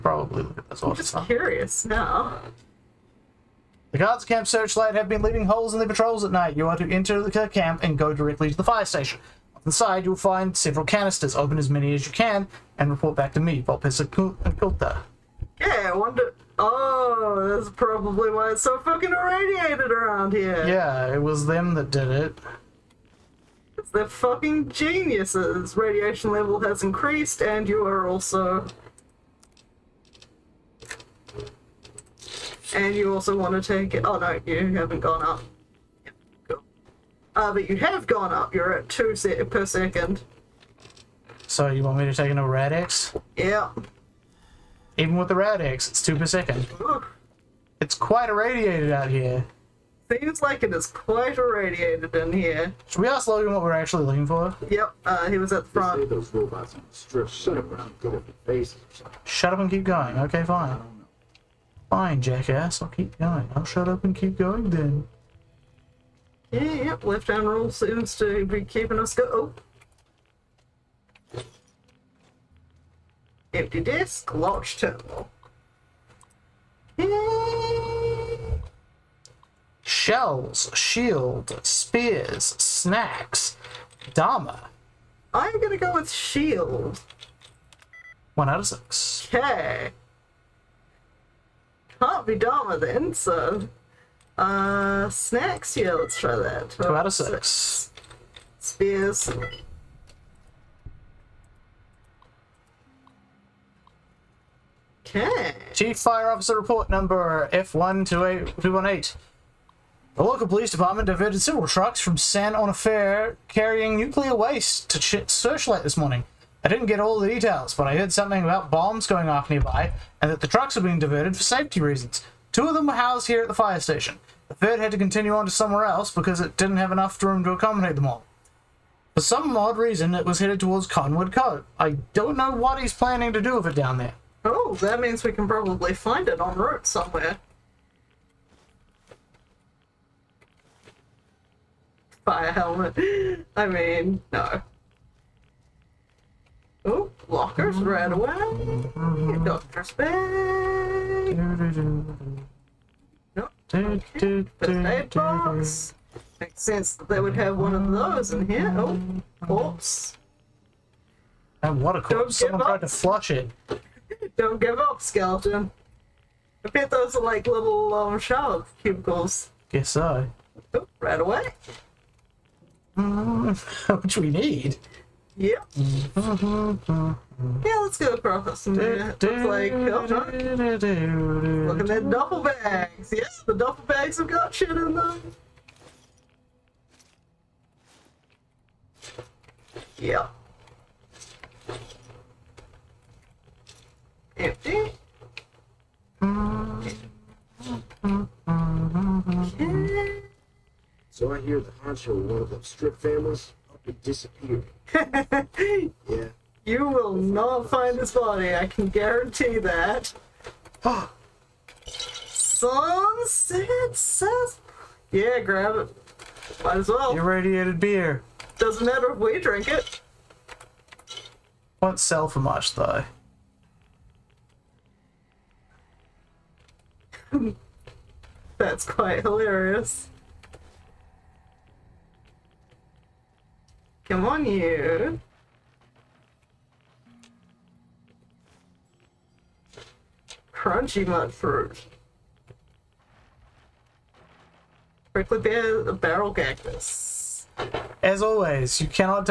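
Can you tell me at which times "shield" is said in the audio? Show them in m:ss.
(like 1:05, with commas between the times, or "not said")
1:20, 1:26.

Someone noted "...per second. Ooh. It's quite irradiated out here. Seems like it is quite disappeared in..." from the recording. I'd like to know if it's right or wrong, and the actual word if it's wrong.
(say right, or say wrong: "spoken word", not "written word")
wrong: "irradiated", not "disappeared".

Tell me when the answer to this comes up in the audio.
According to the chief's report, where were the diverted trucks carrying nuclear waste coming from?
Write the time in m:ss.
1:52.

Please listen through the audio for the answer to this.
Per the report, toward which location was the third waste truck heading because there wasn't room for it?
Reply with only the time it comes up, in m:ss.
2:10.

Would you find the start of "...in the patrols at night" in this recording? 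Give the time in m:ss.
0:05.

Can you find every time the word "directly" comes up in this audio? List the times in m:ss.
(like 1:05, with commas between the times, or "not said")
0:08.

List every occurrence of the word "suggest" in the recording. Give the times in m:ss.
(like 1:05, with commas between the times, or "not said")
not said.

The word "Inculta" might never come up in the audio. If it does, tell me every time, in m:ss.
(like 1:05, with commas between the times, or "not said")
0:13.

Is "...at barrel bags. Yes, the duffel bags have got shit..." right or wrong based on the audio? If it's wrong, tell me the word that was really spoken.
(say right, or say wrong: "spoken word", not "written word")
wrong: "duffel", not "barrel".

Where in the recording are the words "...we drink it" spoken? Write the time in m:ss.
3:39.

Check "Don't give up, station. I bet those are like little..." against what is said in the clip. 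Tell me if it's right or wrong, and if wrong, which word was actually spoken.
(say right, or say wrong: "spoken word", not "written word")
wrong: "skeleton", not "station".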